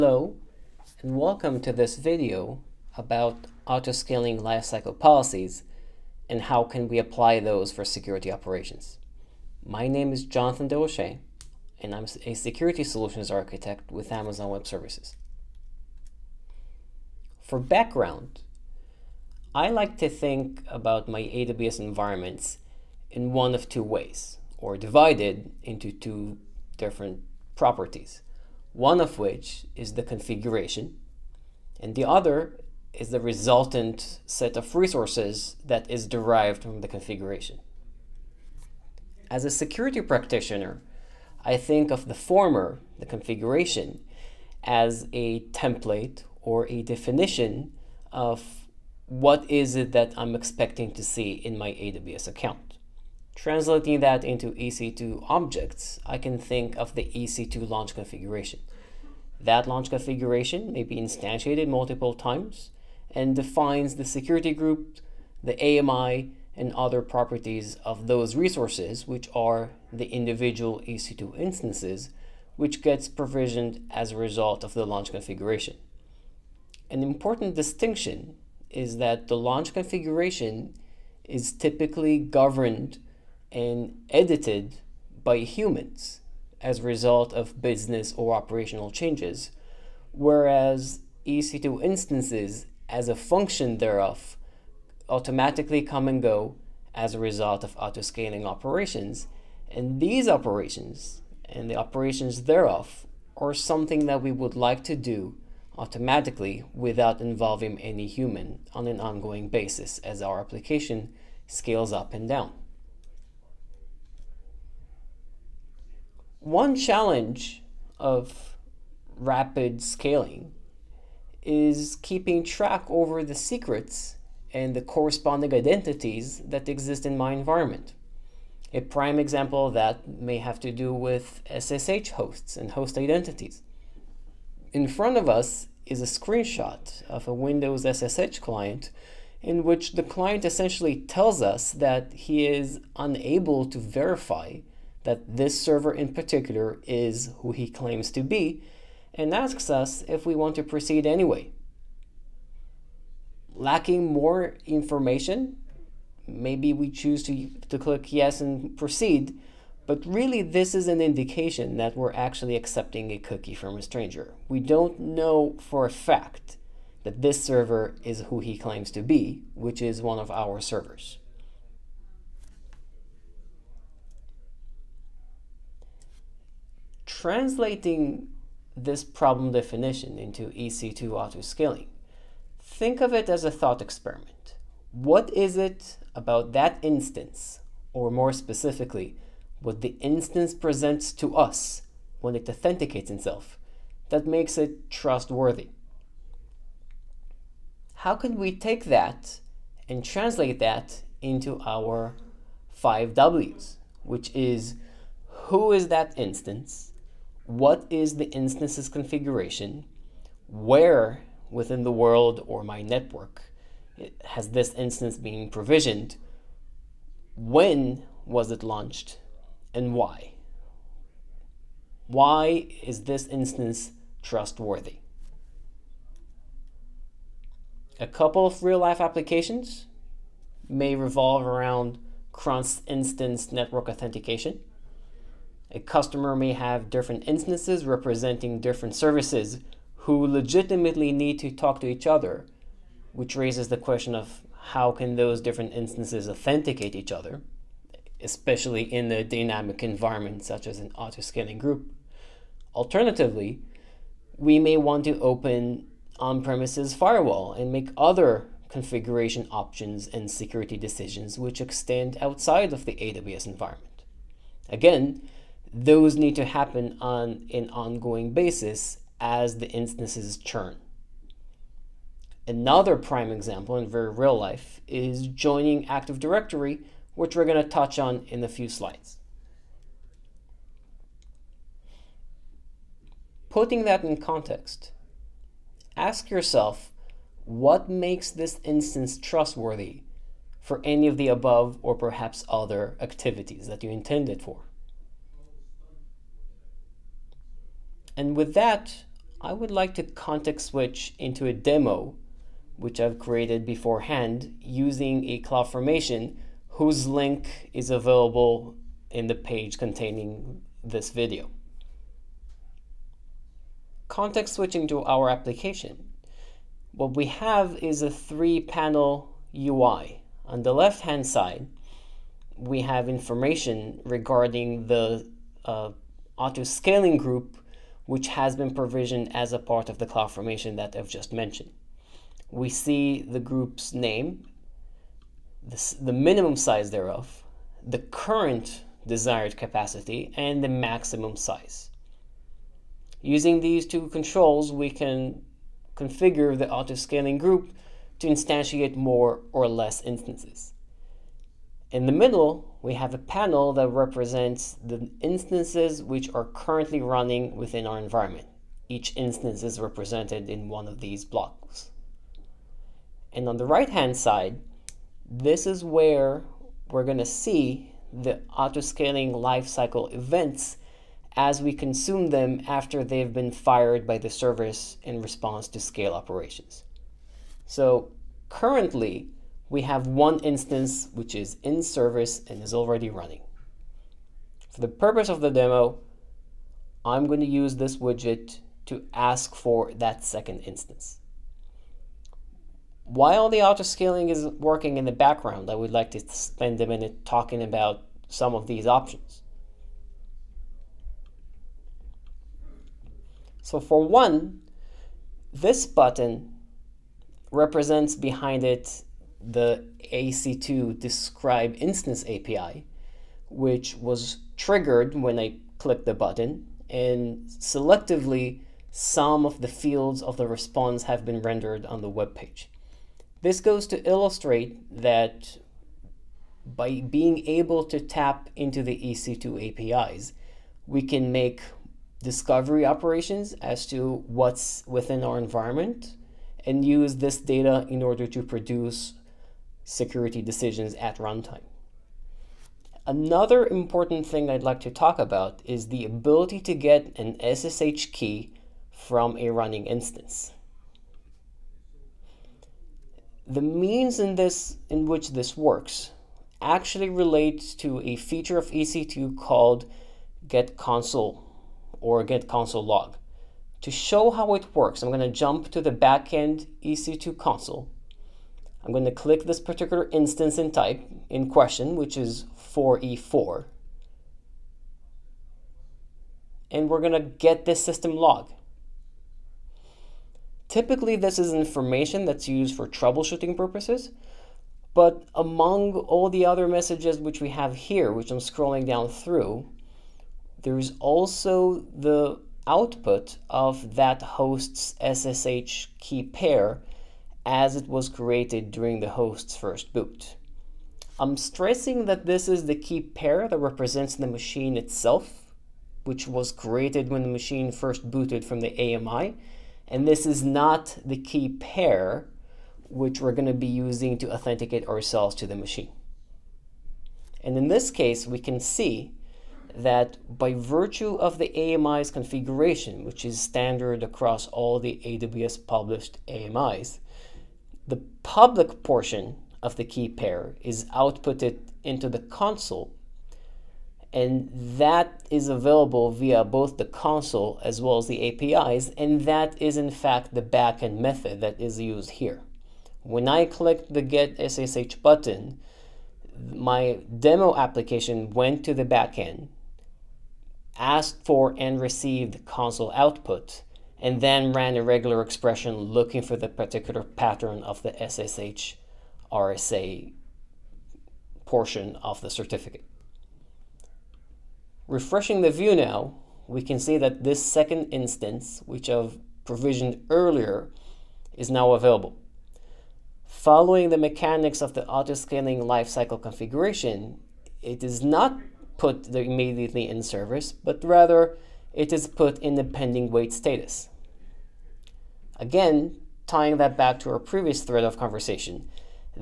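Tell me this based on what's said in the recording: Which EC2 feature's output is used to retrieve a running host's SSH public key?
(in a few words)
Get console log.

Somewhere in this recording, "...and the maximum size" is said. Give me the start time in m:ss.
5:40.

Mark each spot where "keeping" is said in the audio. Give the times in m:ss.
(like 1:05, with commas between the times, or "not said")
2:02.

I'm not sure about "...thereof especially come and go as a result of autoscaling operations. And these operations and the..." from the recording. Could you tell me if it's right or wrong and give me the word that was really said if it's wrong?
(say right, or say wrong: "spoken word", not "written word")
wrong: "automatically", not "especially".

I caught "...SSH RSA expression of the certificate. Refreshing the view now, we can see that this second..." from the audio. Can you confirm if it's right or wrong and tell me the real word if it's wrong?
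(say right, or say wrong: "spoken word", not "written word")
wrong: "portion", not "expression".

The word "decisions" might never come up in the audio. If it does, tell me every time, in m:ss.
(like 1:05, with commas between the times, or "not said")
4:20, 7:20.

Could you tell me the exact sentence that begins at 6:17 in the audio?
So currently, we have one instance which is in service and is already running.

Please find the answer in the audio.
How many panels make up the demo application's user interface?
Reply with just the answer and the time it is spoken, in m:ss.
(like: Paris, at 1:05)
3, at 5:18.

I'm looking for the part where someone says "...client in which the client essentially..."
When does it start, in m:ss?
2:18.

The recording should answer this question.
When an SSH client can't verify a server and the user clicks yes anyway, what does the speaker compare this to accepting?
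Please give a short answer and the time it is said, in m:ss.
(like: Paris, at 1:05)
A cookie from a stranger, at 2:43.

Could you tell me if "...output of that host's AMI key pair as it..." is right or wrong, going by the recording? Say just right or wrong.
wrong.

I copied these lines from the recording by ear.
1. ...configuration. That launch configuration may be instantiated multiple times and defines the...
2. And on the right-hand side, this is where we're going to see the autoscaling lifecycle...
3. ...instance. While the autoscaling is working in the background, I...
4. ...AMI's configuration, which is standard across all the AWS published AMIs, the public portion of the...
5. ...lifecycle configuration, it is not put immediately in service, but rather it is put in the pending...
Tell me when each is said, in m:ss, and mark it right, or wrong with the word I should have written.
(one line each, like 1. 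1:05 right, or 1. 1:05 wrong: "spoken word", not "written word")
1. 0:57 right
2. 6:03 right
3. 6:30 right
4. 8:41 right
5. 9:35 right.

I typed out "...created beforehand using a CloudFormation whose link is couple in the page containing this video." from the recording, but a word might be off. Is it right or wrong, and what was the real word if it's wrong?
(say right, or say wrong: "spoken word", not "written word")
wrong: "available", not "couple".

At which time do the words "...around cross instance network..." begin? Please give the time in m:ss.
3:51.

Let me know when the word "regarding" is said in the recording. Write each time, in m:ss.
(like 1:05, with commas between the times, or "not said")
5:24.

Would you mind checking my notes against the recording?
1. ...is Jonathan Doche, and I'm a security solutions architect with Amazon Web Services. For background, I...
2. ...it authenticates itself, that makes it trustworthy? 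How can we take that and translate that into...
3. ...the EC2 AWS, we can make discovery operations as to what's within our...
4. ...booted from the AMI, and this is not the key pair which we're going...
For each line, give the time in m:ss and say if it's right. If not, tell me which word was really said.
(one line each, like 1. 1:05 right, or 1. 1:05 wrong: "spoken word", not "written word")
1. 0:10 right
2. 3:12 right
3. 7:08 wrong: "APIs", not "AWS"
4. 8:28 right.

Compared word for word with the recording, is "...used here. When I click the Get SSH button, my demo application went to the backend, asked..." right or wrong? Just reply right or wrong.
right.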